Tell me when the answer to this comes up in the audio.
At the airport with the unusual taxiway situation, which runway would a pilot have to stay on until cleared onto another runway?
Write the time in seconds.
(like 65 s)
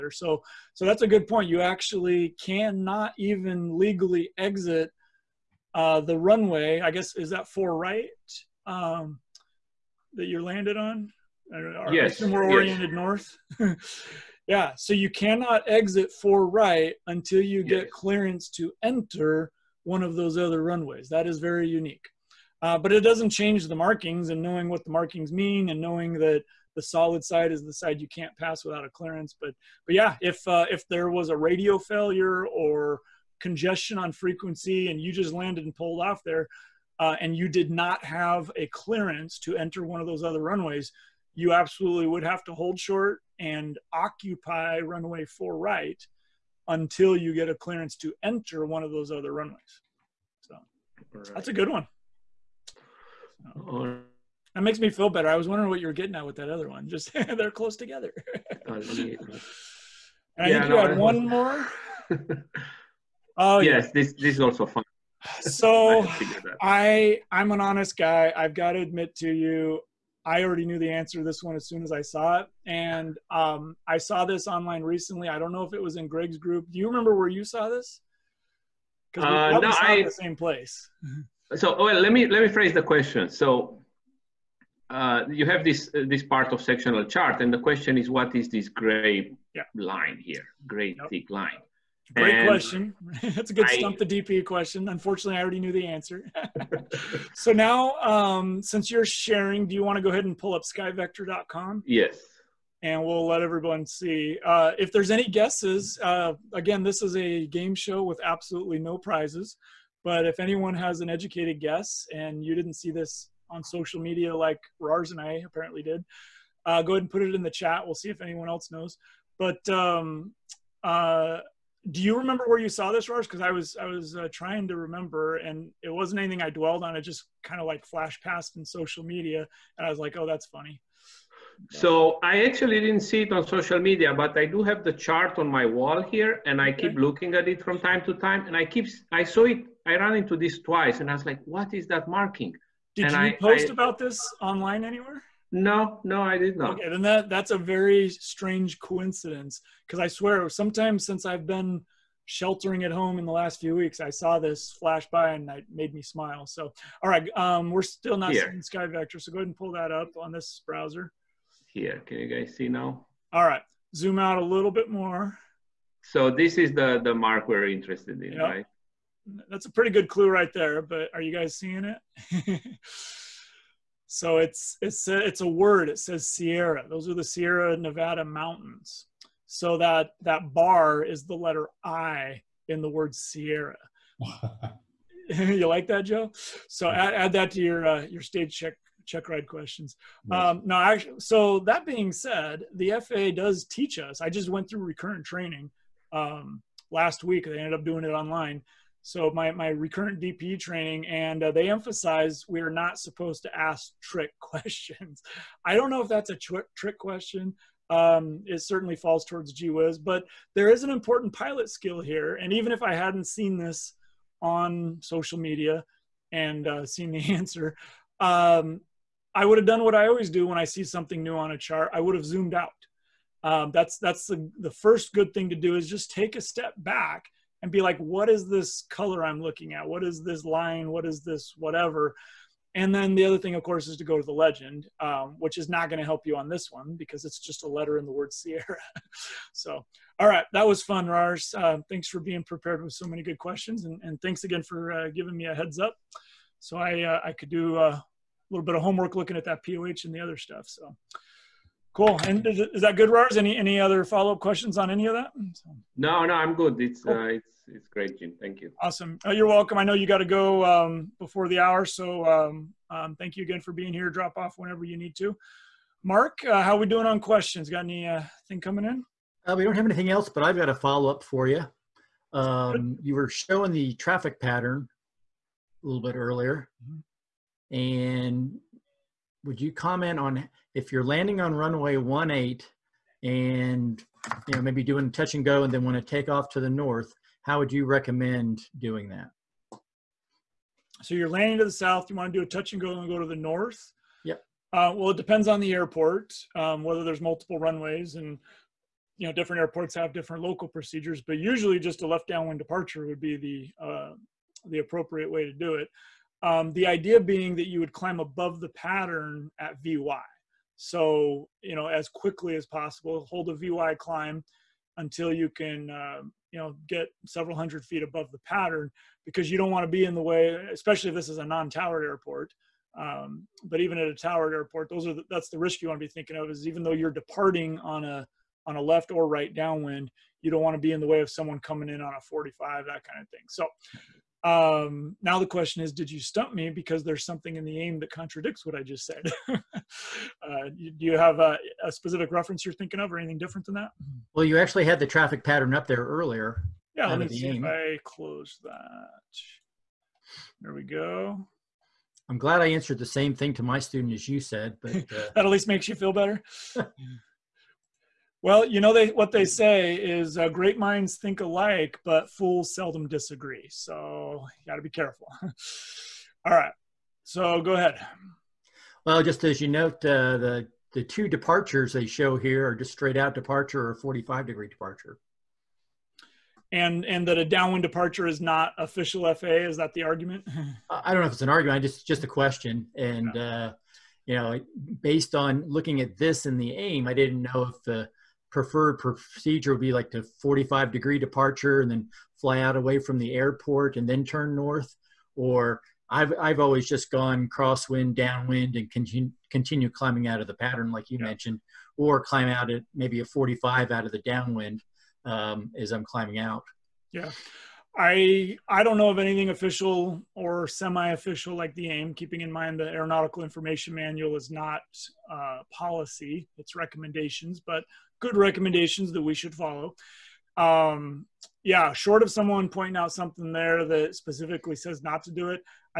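44 s.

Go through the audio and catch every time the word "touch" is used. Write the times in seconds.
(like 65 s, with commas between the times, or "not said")
285 s, 292 s.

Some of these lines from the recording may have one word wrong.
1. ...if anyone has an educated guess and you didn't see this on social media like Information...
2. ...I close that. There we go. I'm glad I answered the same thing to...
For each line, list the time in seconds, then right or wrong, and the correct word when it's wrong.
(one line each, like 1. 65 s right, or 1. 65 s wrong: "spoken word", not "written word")
1. 110 s wrong: "Rars", not "Information"
2. 347 s right.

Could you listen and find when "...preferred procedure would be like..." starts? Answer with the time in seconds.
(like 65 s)
388 s.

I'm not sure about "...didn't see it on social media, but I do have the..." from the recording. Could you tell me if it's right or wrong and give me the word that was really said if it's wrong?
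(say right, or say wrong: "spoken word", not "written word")
right.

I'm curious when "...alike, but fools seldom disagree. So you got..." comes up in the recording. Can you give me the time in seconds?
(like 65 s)
361 s.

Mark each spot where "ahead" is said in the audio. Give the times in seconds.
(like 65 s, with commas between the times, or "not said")
100 s, 116 s, 159 s, 367 s.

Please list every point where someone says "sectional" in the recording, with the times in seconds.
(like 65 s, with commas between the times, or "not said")
86 s.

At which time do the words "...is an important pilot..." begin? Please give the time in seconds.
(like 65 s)
210 s.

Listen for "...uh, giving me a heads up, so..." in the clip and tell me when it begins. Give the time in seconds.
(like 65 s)
244 s.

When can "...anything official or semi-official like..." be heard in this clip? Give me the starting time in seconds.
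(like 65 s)
409 s.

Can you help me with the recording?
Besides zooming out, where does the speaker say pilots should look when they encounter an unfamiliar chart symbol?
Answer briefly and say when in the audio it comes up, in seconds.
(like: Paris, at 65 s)
The legend, at 234 s.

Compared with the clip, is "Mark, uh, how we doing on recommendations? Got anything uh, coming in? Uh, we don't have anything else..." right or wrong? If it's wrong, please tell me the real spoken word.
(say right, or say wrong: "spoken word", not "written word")
wrong: "questions", not "recommendations".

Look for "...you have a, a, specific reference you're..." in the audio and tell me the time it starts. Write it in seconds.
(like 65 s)
341 s.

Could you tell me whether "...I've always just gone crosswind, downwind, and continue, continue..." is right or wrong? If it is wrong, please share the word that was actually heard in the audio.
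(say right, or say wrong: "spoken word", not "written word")
right.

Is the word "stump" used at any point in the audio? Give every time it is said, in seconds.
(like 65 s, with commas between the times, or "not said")
93 s, 336 s.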